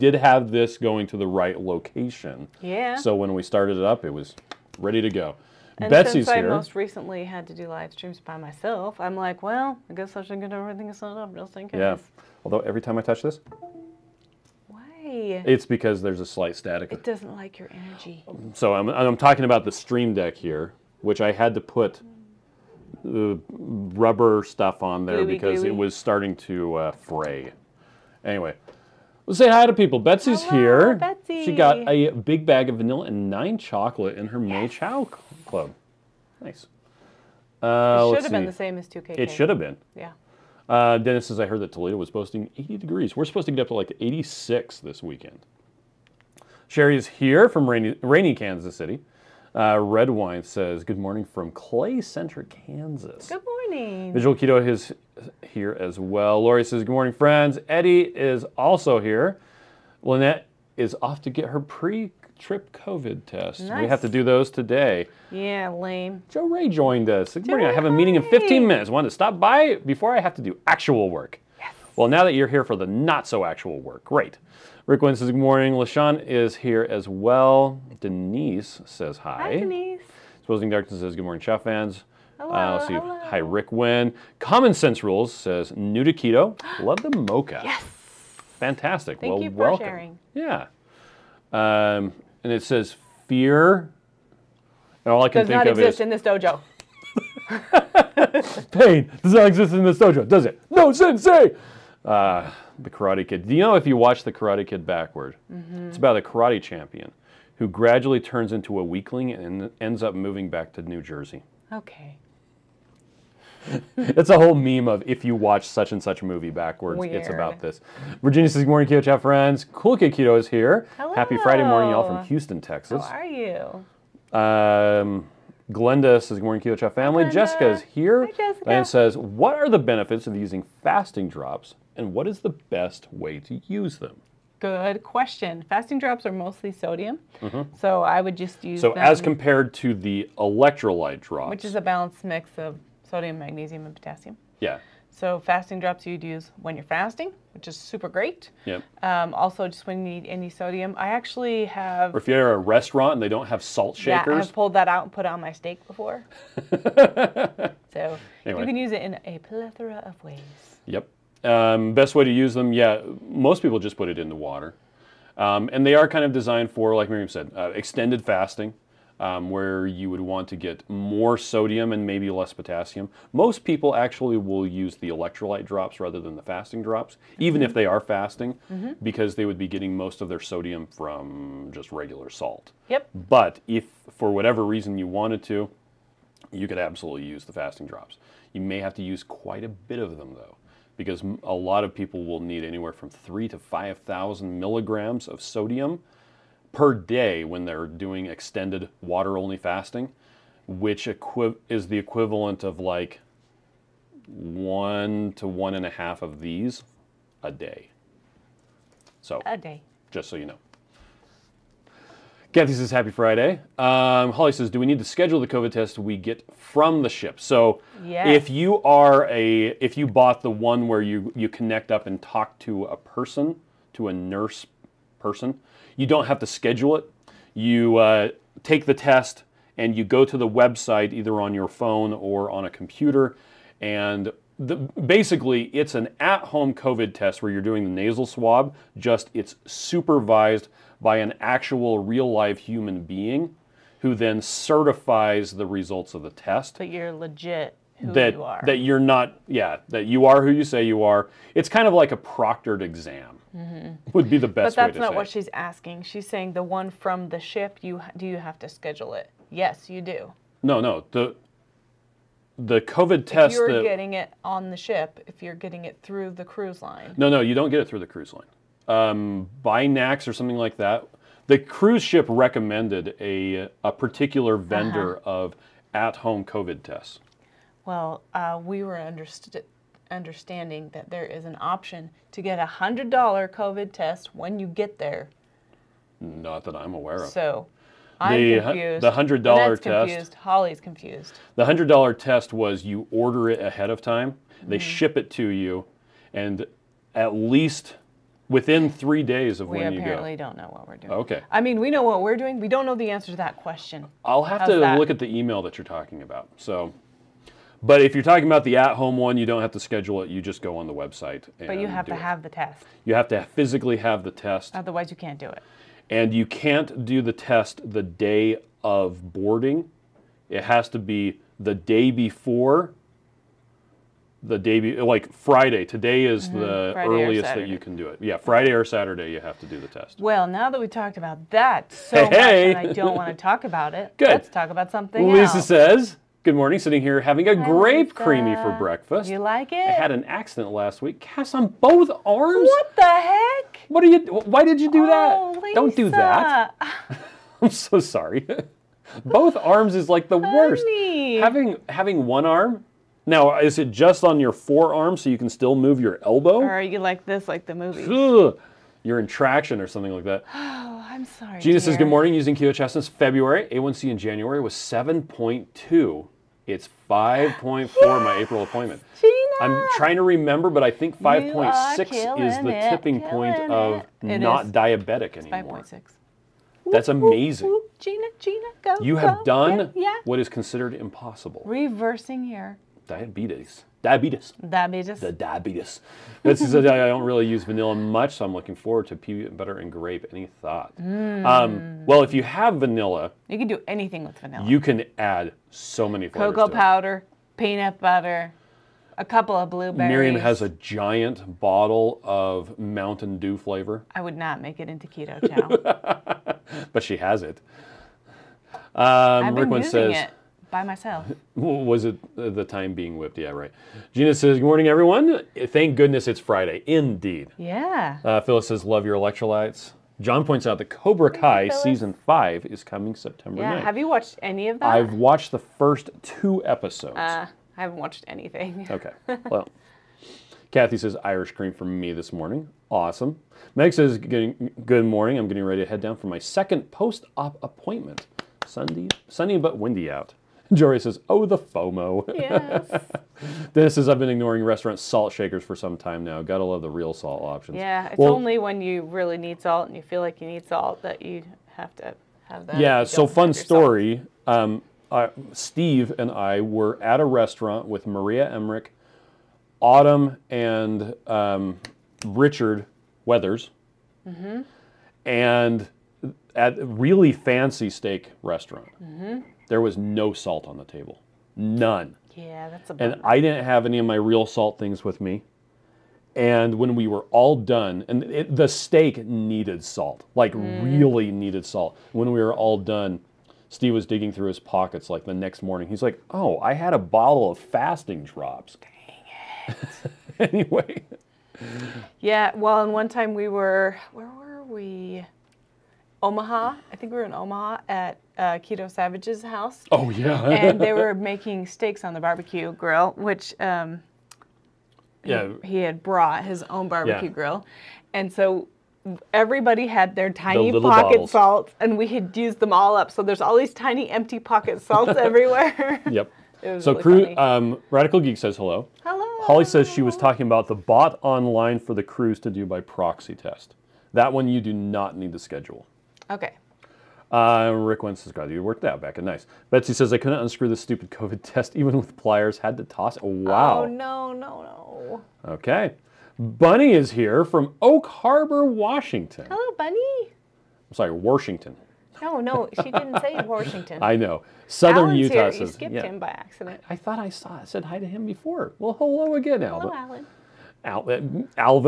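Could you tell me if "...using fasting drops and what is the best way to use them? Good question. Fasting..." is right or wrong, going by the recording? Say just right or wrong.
right.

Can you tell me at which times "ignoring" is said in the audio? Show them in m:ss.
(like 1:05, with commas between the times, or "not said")
7:24.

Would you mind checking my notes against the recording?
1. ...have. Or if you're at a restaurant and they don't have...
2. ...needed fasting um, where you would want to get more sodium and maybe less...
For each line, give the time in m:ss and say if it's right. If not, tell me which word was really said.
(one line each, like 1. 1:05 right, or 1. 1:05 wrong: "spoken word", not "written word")
1. 2:31 right
2. 2:47 wrong: "extended", not "needed".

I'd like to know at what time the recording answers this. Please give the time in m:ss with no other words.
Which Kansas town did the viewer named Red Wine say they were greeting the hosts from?
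0:51.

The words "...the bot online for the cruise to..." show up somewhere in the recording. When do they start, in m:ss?
8:40.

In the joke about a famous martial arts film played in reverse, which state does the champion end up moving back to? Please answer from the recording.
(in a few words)
New Jersey.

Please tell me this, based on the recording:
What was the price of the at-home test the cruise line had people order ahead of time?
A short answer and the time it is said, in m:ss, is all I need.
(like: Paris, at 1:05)
$100, at 4:42.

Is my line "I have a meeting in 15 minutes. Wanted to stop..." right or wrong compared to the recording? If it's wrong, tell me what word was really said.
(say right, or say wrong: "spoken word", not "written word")
right.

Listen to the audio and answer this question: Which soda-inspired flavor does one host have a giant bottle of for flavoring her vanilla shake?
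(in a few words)
Mountain Dew.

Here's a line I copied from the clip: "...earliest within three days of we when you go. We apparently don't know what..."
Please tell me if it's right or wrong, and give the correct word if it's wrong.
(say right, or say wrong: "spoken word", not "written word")
wrong: "least", not "earliest".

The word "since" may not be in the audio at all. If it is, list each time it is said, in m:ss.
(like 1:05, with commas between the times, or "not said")
0:06, 6:02.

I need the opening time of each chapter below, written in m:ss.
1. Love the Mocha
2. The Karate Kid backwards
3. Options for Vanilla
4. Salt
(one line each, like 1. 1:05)
1. 1:24
2. 1:42
3. 6:26
4. 7:23.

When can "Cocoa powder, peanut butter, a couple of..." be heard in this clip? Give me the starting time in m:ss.
6:36.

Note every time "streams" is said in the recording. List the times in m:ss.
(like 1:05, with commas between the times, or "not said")
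0:07, 0:19.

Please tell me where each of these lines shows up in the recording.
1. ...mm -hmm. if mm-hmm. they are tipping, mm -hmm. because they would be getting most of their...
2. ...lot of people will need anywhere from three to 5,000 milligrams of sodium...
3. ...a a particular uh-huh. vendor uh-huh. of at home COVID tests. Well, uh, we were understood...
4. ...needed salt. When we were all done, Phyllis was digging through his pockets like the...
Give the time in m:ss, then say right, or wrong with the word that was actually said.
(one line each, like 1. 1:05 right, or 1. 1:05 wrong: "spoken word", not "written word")
1. 2:57 wrong: "fasting", not "tipping"
2. 3:11 right
3. 4:33 right
4. 8:01 wrong: "Steve", not "Phyllis".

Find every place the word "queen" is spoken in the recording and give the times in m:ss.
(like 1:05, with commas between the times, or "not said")
not said.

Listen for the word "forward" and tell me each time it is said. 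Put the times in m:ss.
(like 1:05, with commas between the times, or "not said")
6:28.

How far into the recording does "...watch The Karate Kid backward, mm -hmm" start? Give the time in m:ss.
1:43.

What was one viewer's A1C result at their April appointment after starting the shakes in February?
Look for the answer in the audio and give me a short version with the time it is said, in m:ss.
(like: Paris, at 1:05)
5.4, at 6:07.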